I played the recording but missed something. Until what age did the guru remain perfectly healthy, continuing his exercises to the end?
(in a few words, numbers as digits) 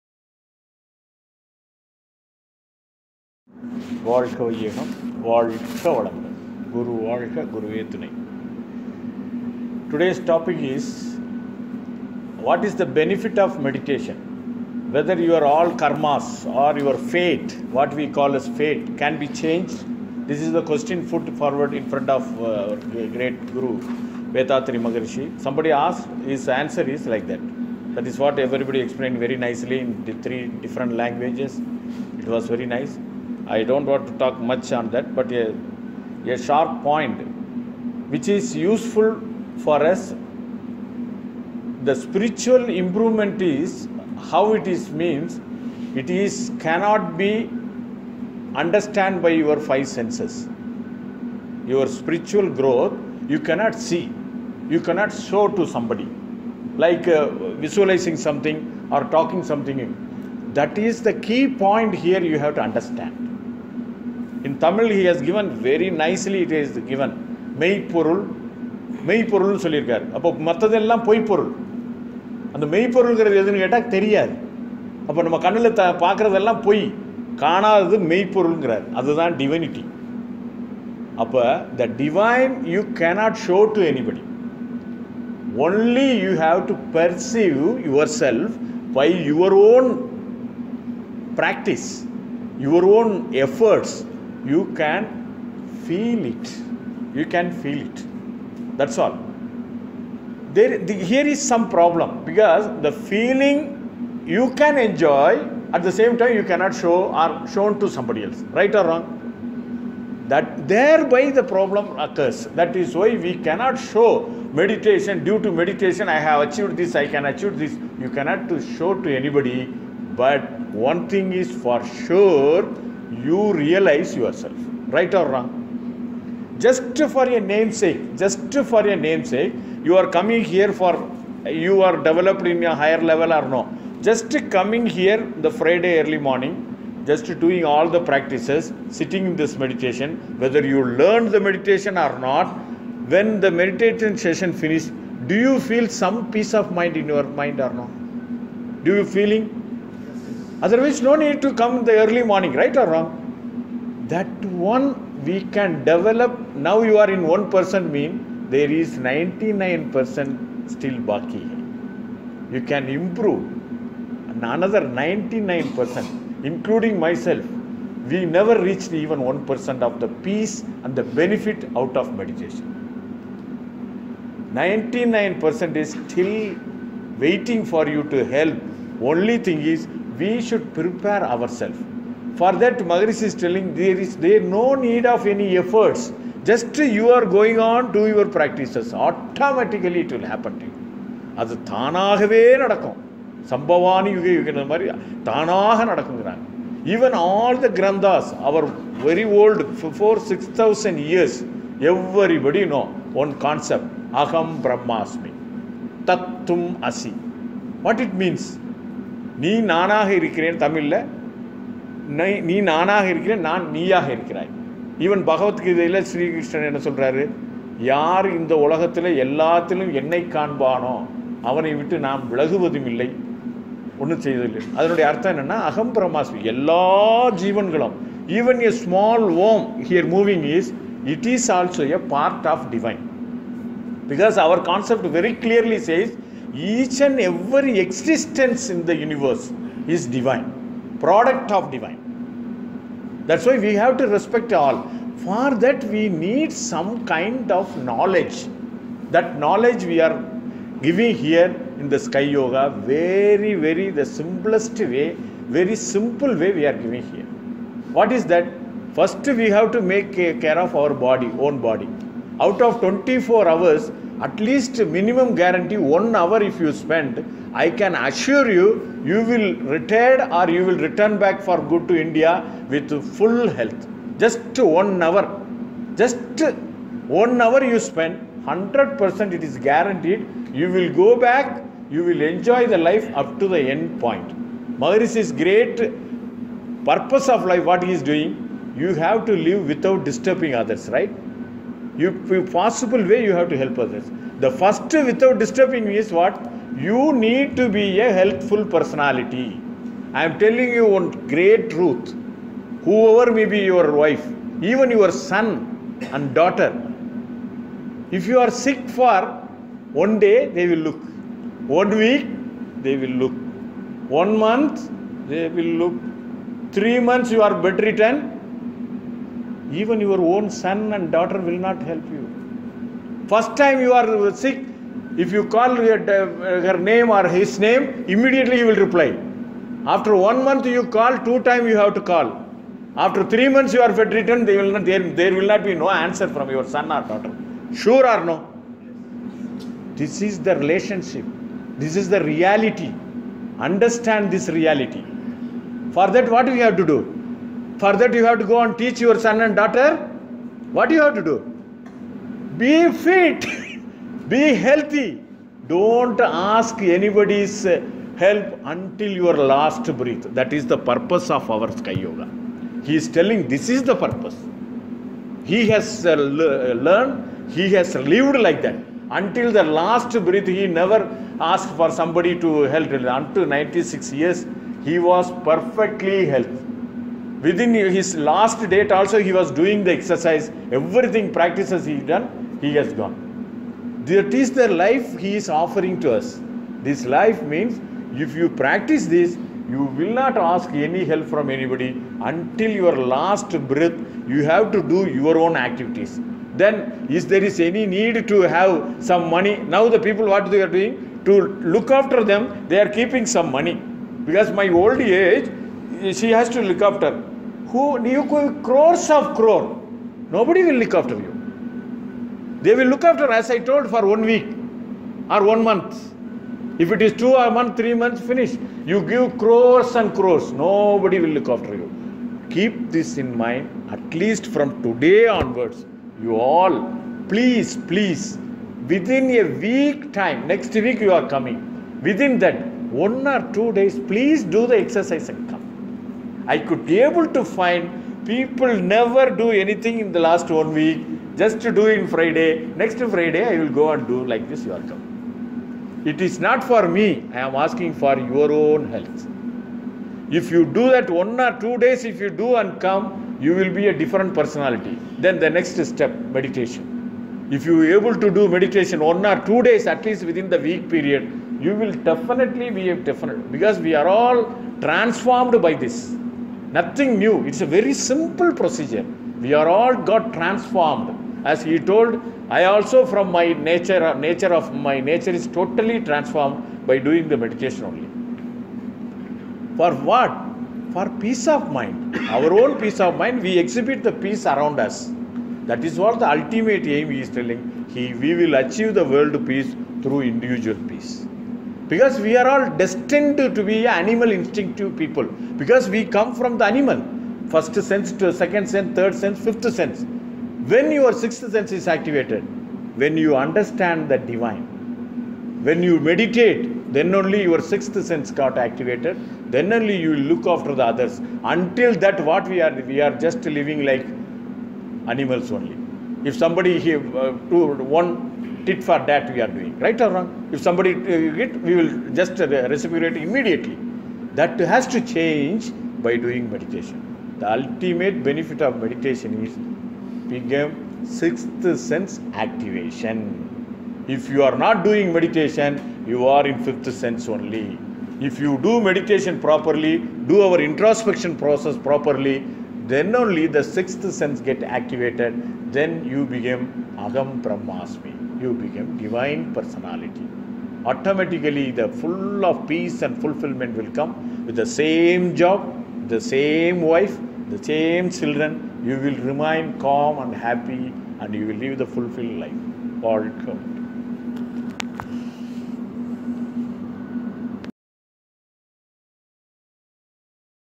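96.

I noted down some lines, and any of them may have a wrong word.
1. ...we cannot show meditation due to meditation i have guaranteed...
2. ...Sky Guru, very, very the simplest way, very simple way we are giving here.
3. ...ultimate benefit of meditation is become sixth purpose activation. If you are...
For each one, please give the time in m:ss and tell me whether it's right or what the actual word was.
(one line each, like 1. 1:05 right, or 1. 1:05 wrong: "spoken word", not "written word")
1. 1:53 wrong: "achieved", not "guaranteed"
2. 4:11 wrong: "Yoga", not "Guru"
3. 8:47 wrong: "sense", not "purpose".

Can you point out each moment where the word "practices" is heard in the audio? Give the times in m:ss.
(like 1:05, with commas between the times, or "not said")
2:17, 3:08, 6:21, 6:28.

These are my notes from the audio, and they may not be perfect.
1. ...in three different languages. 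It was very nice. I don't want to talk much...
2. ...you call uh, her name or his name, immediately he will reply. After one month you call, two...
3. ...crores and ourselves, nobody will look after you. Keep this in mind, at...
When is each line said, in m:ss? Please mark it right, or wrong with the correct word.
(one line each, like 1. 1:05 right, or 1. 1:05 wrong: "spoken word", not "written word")
1. 0:29 right
2. 5:25 right
3. 6:59 wrong: "crores", not "ourselves".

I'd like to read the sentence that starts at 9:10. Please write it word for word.
Automatically, the full of peace and fulfillment will come with the same job, the same wife, the same children.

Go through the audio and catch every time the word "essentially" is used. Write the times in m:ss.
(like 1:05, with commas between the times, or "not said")
not said.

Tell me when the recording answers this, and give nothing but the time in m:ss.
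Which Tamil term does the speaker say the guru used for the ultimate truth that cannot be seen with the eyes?
1:07.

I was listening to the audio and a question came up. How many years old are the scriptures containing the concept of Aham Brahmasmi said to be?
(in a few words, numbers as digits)
4,000 to 6,000 years.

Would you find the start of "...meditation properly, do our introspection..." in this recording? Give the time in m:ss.
8:58.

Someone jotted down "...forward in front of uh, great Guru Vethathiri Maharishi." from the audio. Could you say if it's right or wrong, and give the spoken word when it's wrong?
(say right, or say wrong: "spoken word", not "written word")
right.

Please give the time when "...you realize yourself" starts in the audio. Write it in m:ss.
2:03.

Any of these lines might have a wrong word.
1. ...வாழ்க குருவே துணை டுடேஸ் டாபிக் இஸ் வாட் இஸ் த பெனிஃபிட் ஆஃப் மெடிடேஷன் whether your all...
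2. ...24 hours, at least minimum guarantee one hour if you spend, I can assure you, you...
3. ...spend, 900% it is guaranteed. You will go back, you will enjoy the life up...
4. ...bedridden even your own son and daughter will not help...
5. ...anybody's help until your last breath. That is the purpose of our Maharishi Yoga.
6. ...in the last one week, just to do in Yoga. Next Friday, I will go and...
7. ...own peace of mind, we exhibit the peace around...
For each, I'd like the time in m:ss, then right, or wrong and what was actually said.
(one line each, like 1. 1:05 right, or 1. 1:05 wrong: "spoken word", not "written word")
1. 0:07 right
2. 4:22 right
3. 4:37 wrong: "100", not "900"
4. 5:17 right
5. 5:56 wrong: "Sky", not "Maharishi"
6. 7:19 wrong: "Friday", not "Yoga"
7. 8:02 right.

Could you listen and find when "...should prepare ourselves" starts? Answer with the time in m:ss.
3:00.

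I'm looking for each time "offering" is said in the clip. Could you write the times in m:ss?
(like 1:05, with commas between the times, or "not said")
6:25.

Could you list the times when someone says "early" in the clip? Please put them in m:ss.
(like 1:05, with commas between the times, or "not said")
2:15, 2:32.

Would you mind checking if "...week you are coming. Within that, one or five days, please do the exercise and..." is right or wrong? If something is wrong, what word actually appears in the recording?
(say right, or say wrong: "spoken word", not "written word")
wrong: "two", not "five".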